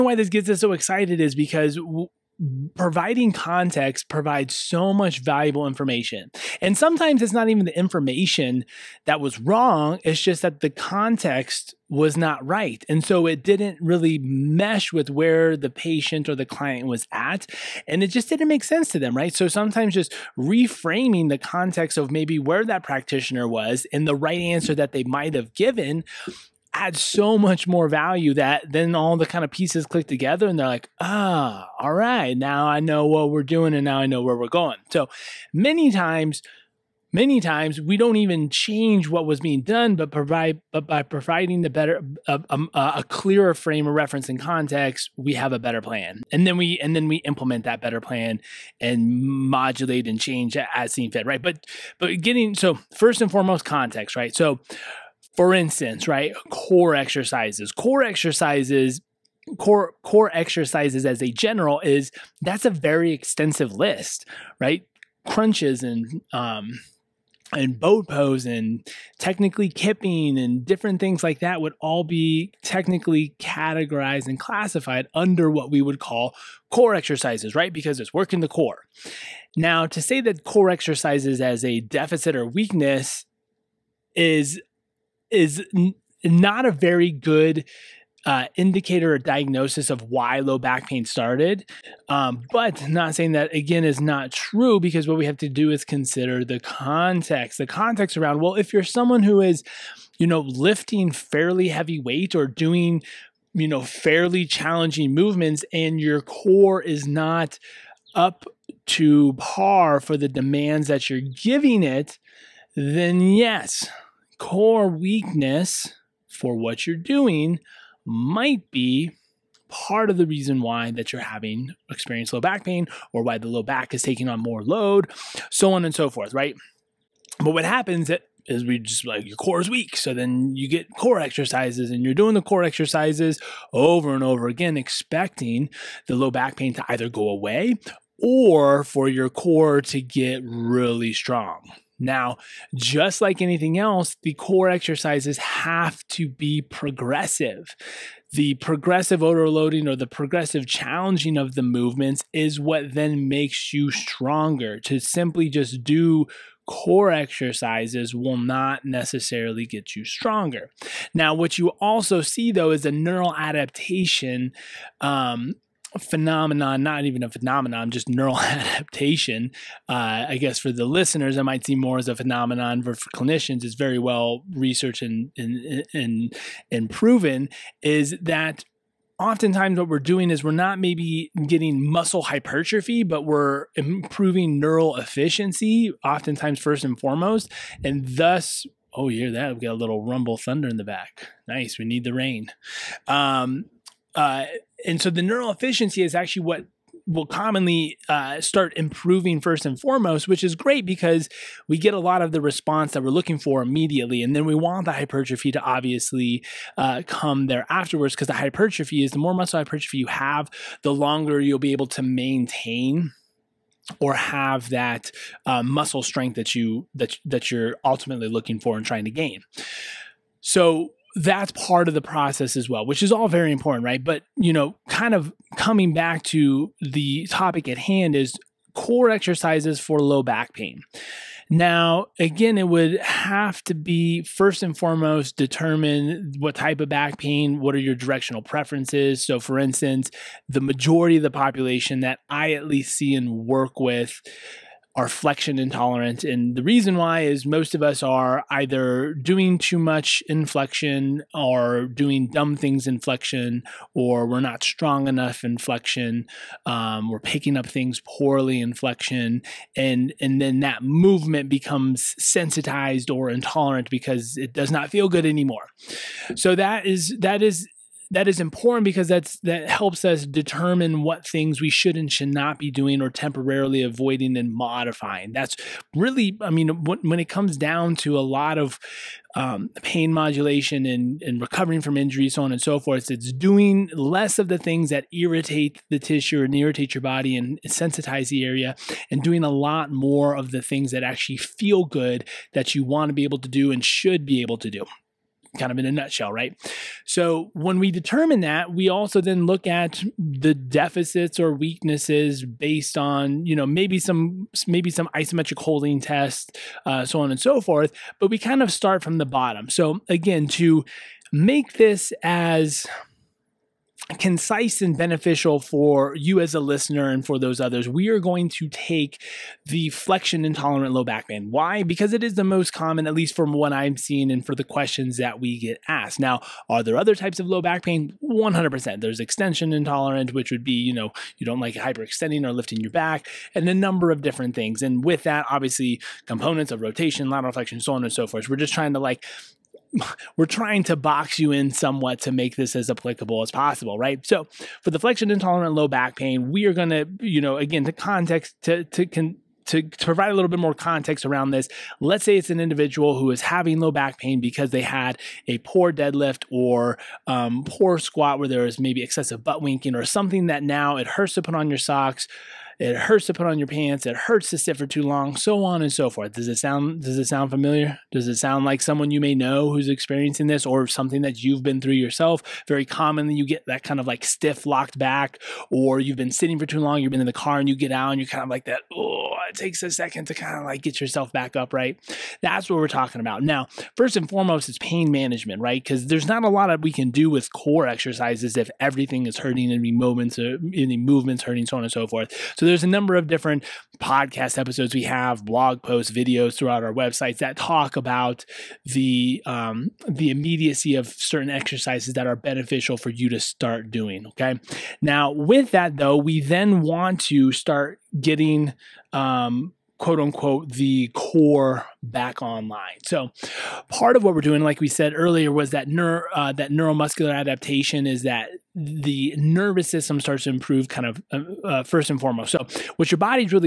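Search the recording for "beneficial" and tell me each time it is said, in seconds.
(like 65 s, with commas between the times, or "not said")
314 s, 402 s.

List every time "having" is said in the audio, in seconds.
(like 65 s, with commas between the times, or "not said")
121 s, 353 s.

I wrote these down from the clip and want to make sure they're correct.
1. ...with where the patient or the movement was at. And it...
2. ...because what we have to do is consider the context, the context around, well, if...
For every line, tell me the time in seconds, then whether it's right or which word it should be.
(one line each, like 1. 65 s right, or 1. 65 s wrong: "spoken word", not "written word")
1. 14 s wrong: "client", not "movement"
2. 94 s right.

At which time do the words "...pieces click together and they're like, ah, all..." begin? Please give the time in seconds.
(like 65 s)
29 s.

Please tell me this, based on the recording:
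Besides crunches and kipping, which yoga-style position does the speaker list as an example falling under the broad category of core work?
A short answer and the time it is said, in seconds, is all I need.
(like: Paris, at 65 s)
boat pose, at 67 s.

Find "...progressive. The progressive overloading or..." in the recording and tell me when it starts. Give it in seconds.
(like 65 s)
146 s.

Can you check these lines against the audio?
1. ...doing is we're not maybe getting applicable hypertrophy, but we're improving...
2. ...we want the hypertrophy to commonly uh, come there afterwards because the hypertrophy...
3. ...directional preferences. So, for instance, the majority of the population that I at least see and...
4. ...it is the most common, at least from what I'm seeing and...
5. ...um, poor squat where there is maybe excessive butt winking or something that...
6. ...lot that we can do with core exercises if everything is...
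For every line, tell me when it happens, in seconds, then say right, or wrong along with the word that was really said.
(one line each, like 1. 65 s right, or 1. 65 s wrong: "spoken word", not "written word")
1. 179 s wrong: "muscle", not "applicable"
2. 204 s wrong: "obviously", not "commonly"
3. 237 s right
4. 322 s right
5. 357 s right
6. 386 s right.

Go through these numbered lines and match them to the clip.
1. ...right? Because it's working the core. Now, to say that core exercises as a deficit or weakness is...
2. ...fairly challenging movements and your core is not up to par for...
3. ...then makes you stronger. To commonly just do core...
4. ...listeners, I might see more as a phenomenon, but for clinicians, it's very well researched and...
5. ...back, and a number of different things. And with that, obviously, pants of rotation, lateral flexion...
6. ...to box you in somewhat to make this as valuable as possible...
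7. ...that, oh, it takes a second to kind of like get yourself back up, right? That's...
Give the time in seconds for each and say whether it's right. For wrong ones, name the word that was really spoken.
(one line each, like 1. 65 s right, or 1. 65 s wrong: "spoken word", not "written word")
1. 77 s right
2. 103 s right
3. 152 s wrong: "simply", not "commonly"
4. 170 s right
5. 332 s wrong: "components", not "pants"
6. 340 s wrong: "applicable", not "valuable"
7. 378 s right.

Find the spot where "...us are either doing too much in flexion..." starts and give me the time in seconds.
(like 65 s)
247 s.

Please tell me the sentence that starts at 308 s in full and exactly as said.
But we kind of start from the bottom.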